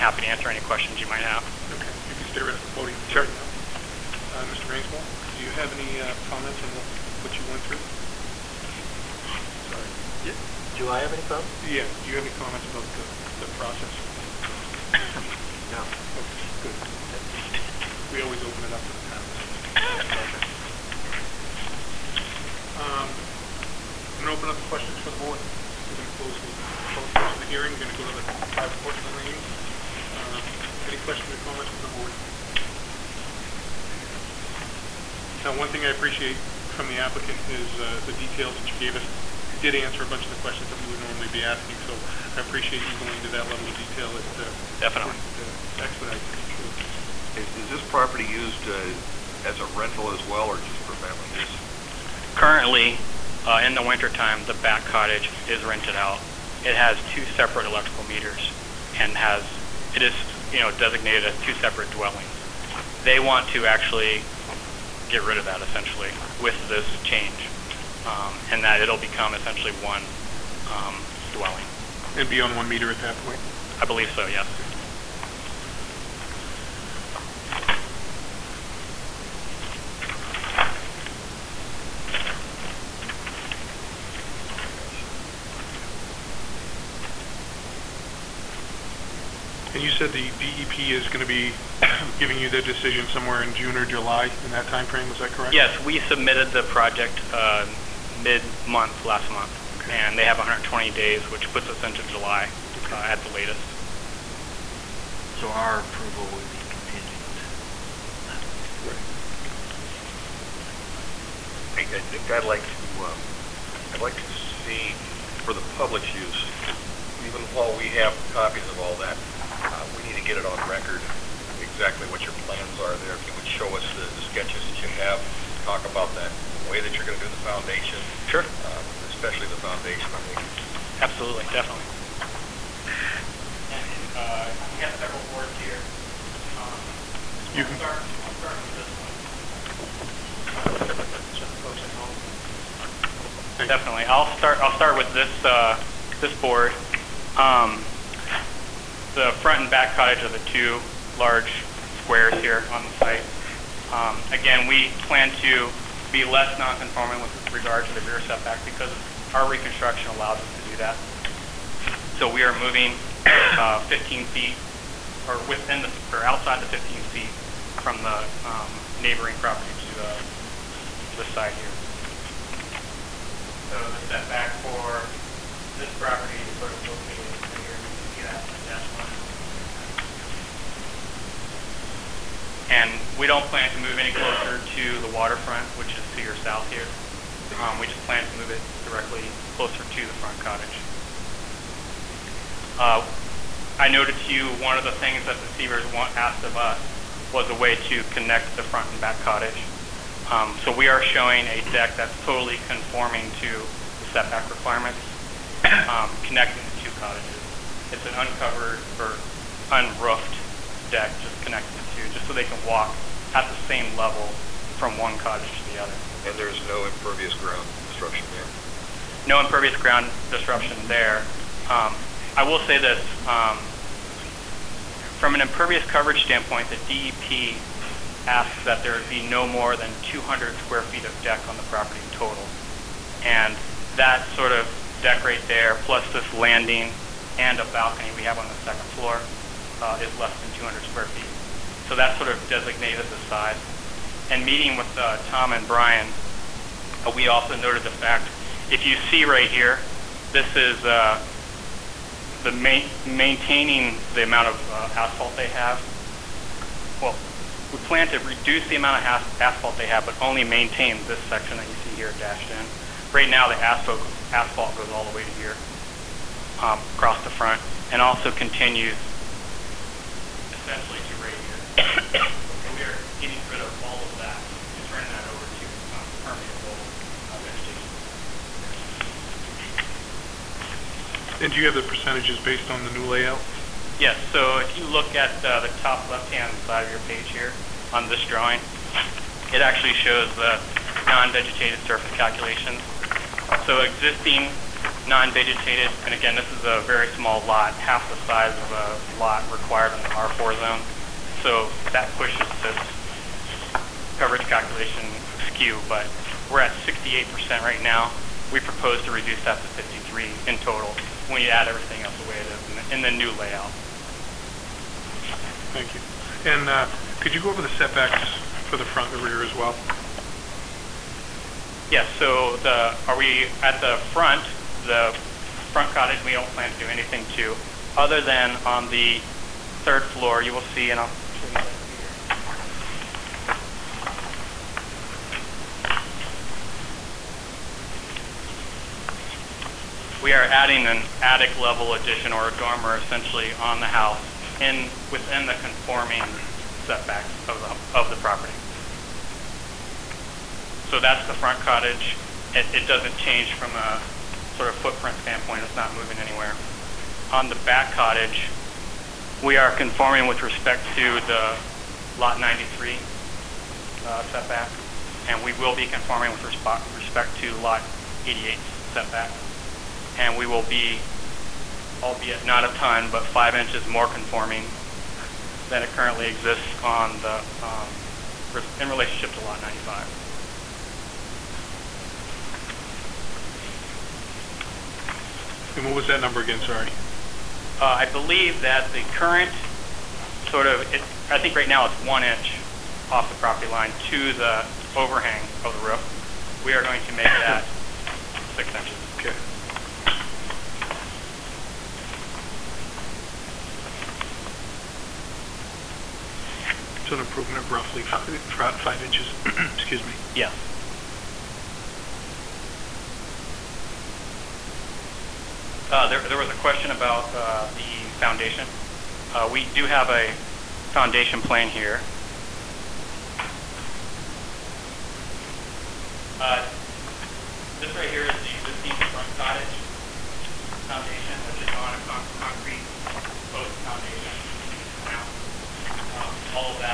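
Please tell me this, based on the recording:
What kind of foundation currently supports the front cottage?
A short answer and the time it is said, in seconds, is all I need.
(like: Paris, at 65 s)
Concrete post foundation, at 432 s.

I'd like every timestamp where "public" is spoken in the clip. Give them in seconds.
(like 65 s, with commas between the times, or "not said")
26 s, 115 s.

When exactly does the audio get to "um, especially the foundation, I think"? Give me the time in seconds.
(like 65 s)
128 s.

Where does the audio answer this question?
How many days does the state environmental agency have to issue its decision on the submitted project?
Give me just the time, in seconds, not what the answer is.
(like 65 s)
100 s.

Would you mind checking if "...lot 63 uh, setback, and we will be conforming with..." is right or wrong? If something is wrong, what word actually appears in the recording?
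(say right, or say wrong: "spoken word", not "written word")
wrong: "93", not "63".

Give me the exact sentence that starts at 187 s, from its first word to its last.
Um, we just plan to move it directly closer to the front cottage.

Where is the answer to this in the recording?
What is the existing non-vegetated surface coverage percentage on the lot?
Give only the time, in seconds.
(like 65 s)
306 s.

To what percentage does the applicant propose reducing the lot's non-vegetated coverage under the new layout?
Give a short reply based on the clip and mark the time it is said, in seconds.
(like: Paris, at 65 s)
53%, at 309 s.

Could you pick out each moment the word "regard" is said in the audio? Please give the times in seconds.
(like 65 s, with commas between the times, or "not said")
157 s.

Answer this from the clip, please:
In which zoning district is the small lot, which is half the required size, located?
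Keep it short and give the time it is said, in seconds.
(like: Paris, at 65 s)
R4, at 300 s.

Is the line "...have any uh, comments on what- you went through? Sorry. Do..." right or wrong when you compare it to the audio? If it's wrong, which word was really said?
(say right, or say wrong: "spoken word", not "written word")
right.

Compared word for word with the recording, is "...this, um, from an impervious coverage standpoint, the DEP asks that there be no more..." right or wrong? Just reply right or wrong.
right.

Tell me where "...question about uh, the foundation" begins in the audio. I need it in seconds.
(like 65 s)
416 s.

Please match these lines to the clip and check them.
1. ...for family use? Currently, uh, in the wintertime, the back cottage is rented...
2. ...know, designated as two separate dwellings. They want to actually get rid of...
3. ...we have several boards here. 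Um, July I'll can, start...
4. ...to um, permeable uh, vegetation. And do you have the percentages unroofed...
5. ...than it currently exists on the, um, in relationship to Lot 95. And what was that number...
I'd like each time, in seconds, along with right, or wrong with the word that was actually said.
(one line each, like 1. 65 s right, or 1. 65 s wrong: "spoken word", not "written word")
1. 50 s right
2. 60 s right
3. 134 s wrong: "You", not "July"
4. 275 s wrong: "based", not "unroofed"
5. 375 s right.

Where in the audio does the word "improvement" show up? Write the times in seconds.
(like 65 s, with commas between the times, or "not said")
407 s.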